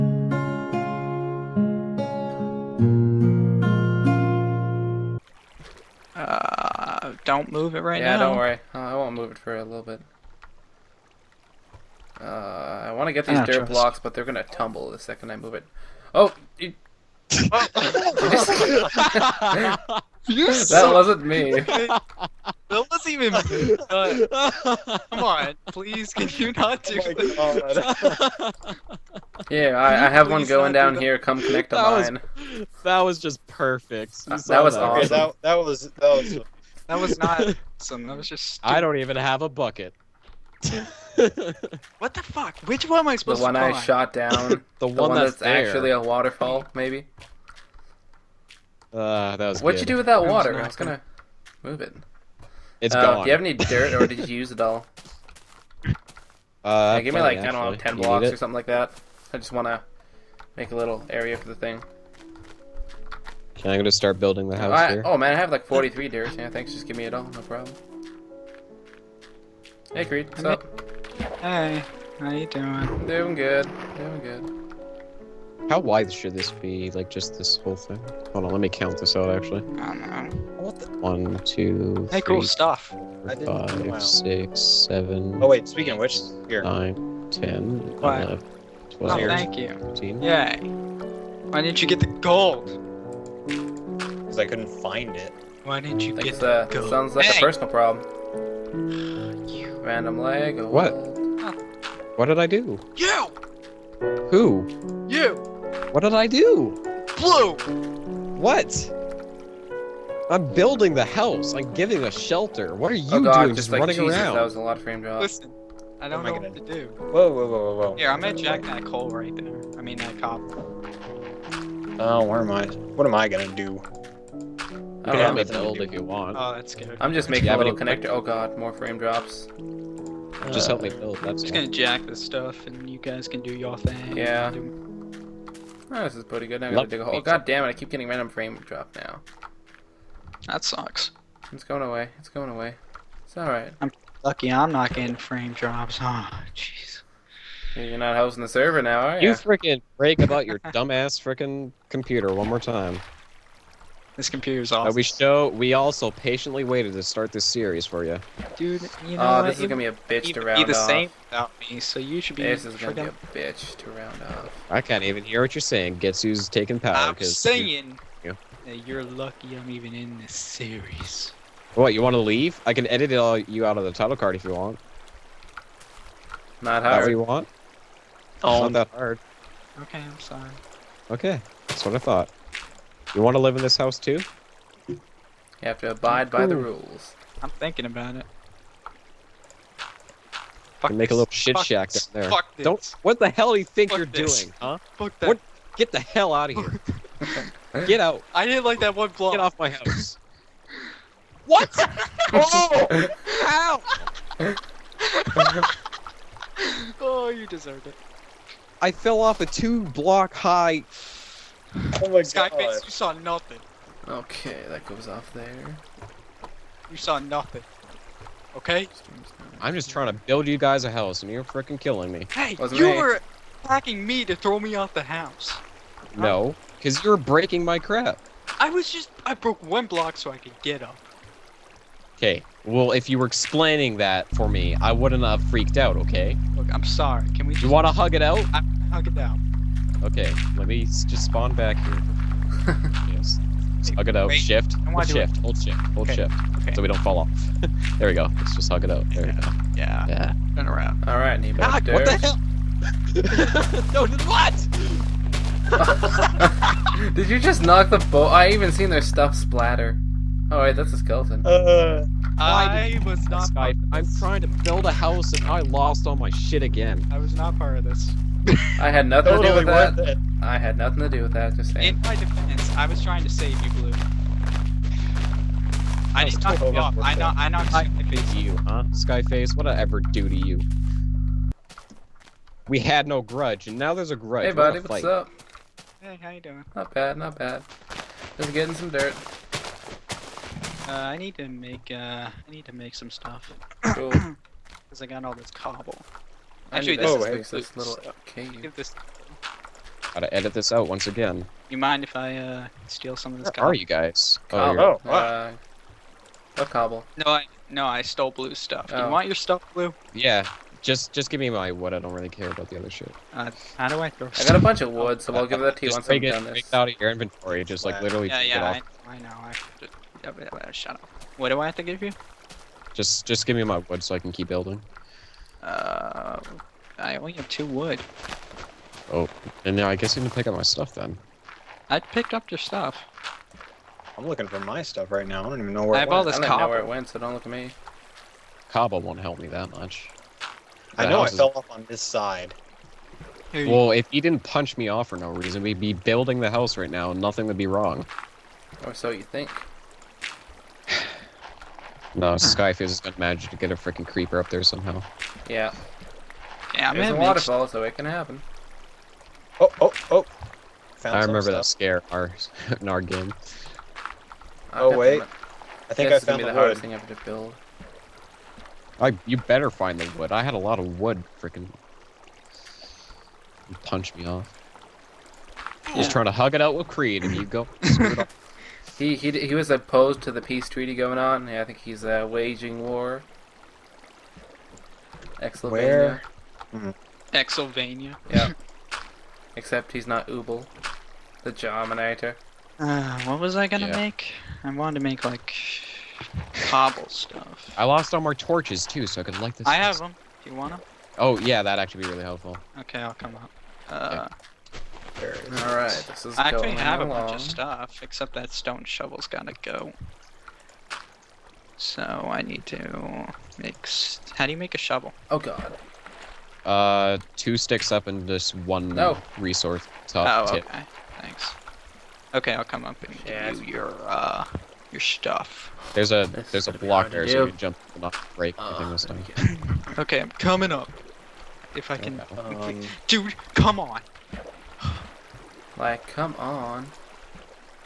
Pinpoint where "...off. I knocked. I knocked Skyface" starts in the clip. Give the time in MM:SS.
04:36.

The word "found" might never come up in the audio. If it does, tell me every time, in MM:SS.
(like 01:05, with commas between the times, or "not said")
06:00, 06:06.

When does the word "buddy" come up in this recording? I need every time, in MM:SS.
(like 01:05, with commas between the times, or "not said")
04:44.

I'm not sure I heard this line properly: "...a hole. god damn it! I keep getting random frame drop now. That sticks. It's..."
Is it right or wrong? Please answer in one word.
wrong.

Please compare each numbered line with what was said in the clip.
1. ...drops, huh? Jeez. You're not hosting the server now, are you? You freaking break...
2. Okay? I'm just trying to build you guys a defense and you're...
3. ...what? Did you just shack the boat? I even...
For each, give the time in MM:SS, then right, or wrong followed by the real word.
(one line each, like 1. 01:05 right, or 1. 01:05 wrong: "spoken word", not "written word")
1. 02:25 right
2. 03:38 wrong: "house", not "defense"
3. 04:15 wrong: "knock", not "shack".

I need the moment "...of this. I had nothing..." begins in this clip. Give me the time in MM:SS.
04:27.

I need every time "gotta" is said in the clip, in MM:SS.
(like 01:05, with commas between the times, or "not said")
02:16, 05:00, 06:49.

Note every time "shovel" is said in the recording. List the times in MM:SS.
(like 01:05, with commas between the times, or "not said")
06:48, 06:54.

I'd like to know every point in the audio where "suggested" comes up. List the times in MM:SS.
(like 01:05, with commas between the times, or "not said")
not said.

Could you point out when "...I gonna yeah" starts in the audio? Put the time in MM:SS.
06:33.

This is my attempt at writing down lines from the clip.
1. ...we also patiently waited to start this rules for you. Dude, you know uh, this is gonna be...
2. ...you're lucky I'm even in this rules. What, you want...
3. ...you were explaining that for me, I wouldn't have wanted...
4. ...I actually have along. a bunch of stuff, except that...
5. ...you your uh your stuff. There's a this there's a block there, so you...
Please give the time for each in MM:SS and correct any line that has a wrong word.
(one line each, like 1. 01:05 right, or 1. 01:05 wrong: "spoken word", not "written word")
1. 02:35 wrong: "series", not "rules"
2. 02:48 wrong: "series", not "rules"
3. 03:53 wrong: "freaked", not "wanted"
4. 06:46 right
5. 07:03 right.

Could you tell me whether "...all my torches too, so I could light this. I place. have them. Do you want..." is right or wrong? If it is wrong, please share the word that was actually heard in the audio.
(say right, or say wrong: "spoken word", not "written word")
right.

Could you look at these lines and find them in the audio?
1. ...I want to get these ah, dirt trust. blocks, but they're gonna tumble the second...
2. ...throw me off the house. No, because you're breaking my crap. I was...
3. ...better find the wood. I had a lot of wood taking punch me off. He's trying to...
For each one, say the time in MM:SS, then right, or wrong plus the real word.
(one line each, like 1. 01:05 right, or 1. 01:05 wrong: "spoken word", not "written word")
1. 00:12 right
2. 03:44 right
3. 06:09 wrong: "freaking", not "taking".